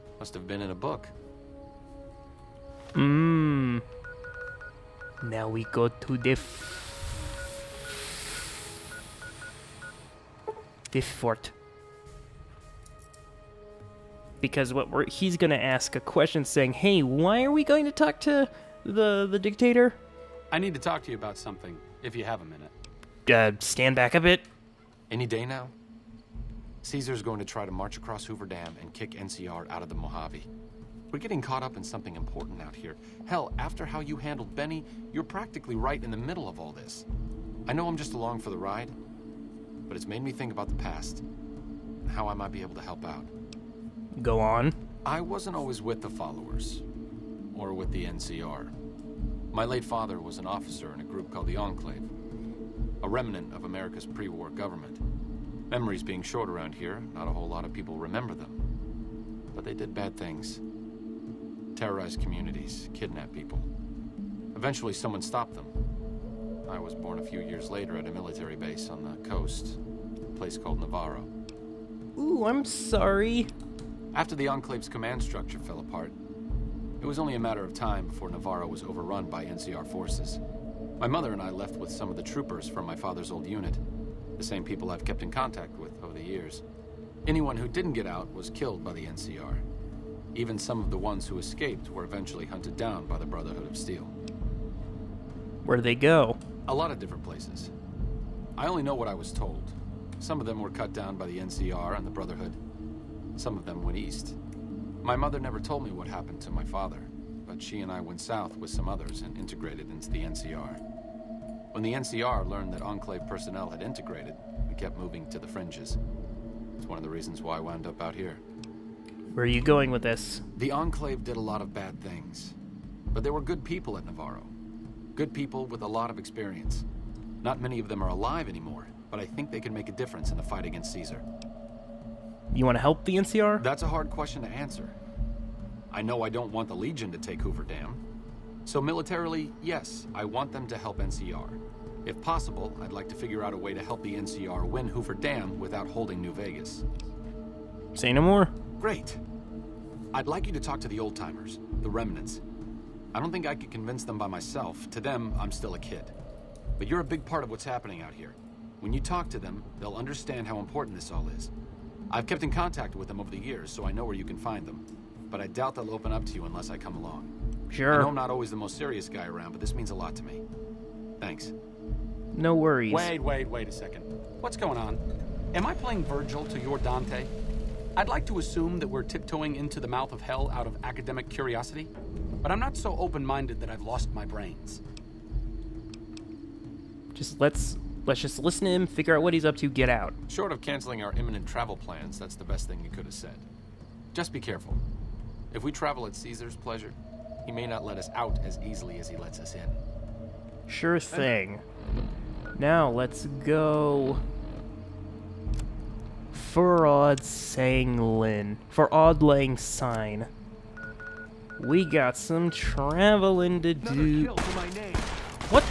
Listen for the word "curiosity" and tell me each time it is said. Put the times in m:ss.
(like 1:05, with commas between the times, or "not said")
3:01.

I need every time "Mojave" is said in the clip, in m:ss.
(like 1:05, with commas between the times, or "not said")
0:29.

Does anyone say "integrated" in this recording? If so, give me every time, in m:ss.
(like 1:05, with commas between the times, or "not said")
1:49, 1:53.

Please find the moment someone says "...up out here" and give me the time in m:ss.
1:57.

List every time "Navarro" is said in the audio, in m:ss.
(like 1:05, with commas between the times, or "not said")
1:10, 1:18, 2:04.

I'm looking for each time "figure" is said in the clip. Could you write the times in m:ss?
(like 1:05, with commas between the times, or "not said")
2:23, 3:08.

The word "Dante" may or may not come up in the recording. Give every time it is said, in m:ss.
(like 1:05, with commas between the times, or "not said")
2:56.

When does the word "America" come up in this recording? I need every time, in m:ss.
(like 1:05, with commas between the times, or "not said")
0:53.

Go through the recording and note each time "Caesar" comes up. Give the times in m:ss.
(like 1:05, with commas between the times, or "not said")
0:26, 2:10, 3:16.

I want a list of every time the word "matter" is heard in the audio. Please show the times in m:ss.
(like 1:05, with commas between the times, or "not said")
1:17.